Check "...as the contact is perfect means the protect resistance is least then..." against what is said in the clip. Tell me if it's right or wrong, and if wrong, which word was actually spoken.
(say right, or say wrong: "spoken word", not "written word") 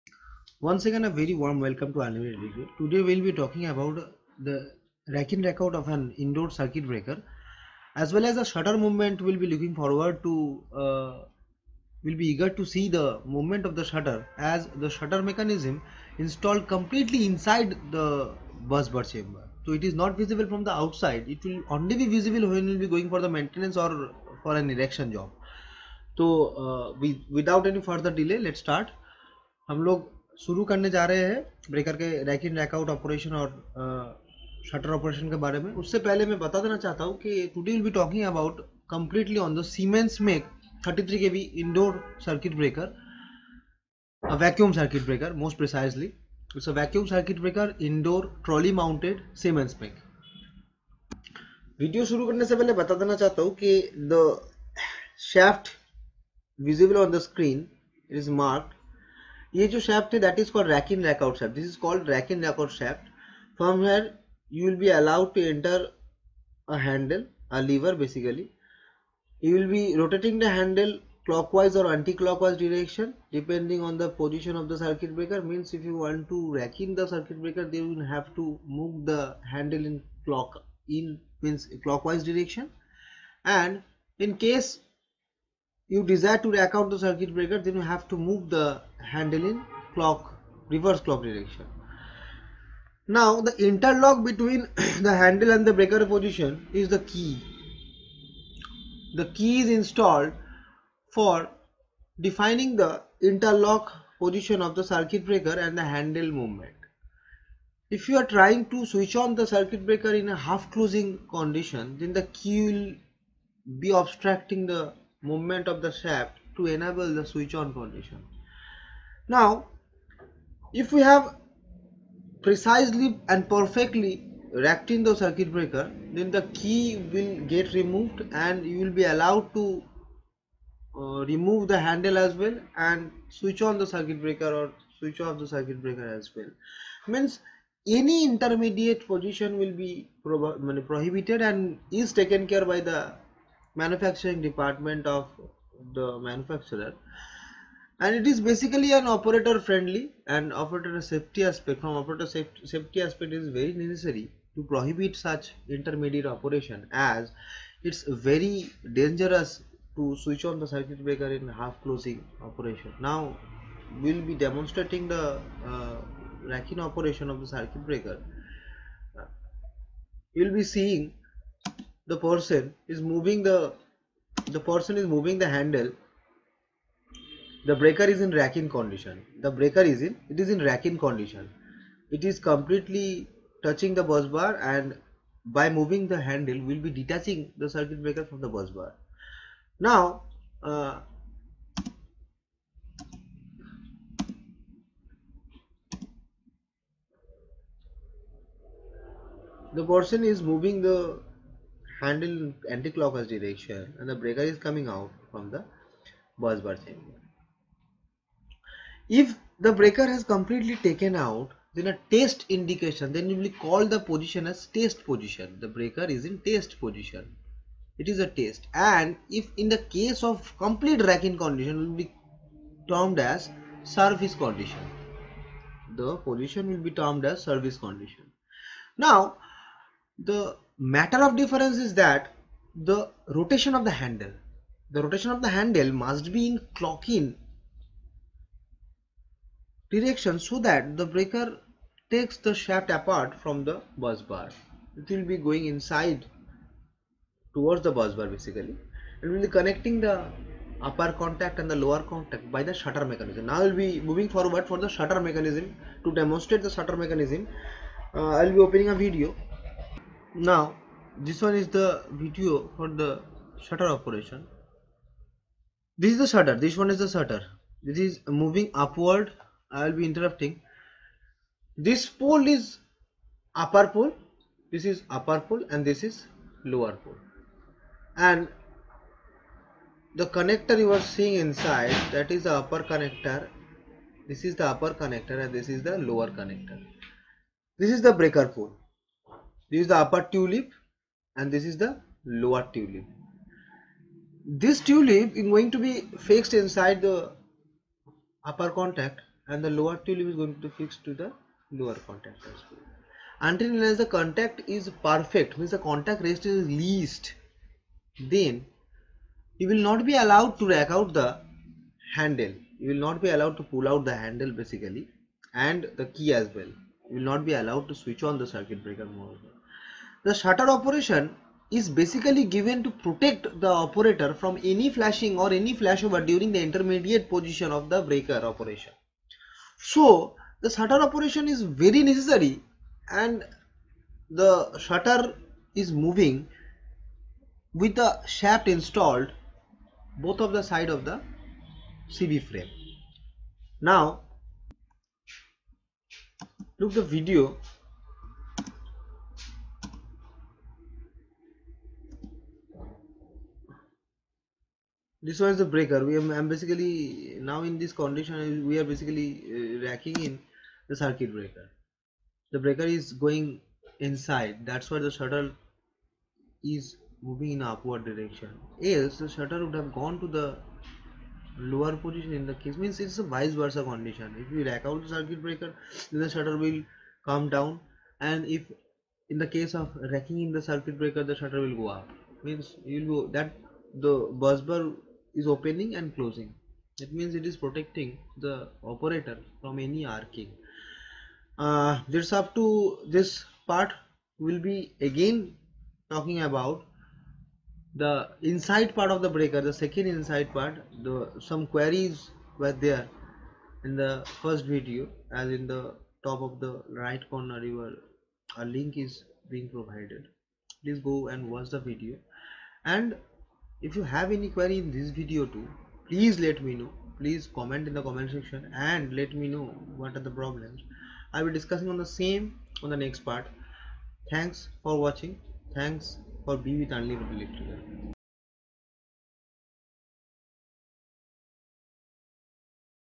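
wrong: "contact", not "protect".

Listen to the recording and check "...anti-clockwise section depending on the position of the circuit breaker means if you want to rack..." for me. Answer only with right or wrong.
wrong.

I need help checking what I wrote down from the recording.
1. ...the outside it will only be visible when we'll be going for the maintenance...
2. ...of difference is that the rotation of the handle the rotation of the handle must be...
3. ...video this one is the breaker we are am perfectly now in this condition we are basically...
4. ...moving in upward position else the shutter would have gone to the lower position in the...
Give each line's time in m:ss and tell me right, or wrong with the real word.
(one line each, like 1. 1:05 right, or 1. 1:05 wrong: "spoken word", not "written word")
1. 0:20 right
2. 3:51 right
3. 5:47 wrong: "basically", not "perfectly"
4. 6:07 wrong: "direction", not "position".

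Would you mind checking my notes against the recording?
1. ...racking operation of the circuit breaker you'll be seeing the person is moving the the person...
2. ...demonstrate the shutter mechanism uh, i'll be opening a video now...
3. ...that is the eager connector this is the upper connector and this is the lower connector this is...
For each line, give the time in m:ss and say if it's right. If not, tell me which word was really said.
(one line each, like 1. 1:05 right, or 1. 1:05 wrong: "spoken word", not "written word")
1. 2:46 right
2. 4:16 right
3. 4:42 wrong: "upper", not "eager".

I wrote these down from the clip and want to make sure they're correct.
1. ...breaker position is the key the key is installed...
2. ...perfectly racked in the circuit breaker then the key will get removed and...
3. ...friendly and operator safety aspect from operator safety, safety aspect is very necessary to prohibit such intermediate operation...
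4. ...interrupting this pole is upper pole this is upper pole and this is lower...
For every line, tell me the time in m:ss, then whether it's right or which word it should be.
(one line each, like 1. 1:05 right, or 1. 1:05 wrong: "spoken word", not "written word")
1. 1:35 right
2. 2:03 right
3. 2:29 right
4. 4:30 right.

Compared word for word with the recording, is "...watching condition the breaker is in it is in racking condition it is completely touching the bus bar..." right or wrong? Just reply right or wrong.
wrong.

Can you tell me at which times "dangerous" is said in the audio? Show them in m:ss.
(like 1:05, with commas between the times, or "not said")
2:38.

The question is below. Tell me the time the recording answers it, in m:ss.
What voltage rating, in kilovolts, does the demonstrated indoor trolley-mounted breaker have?
0:40.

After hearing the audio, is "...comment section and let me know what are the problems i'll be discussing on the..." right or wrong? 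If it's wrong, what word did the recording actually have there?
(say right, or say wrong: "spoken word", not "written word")
right.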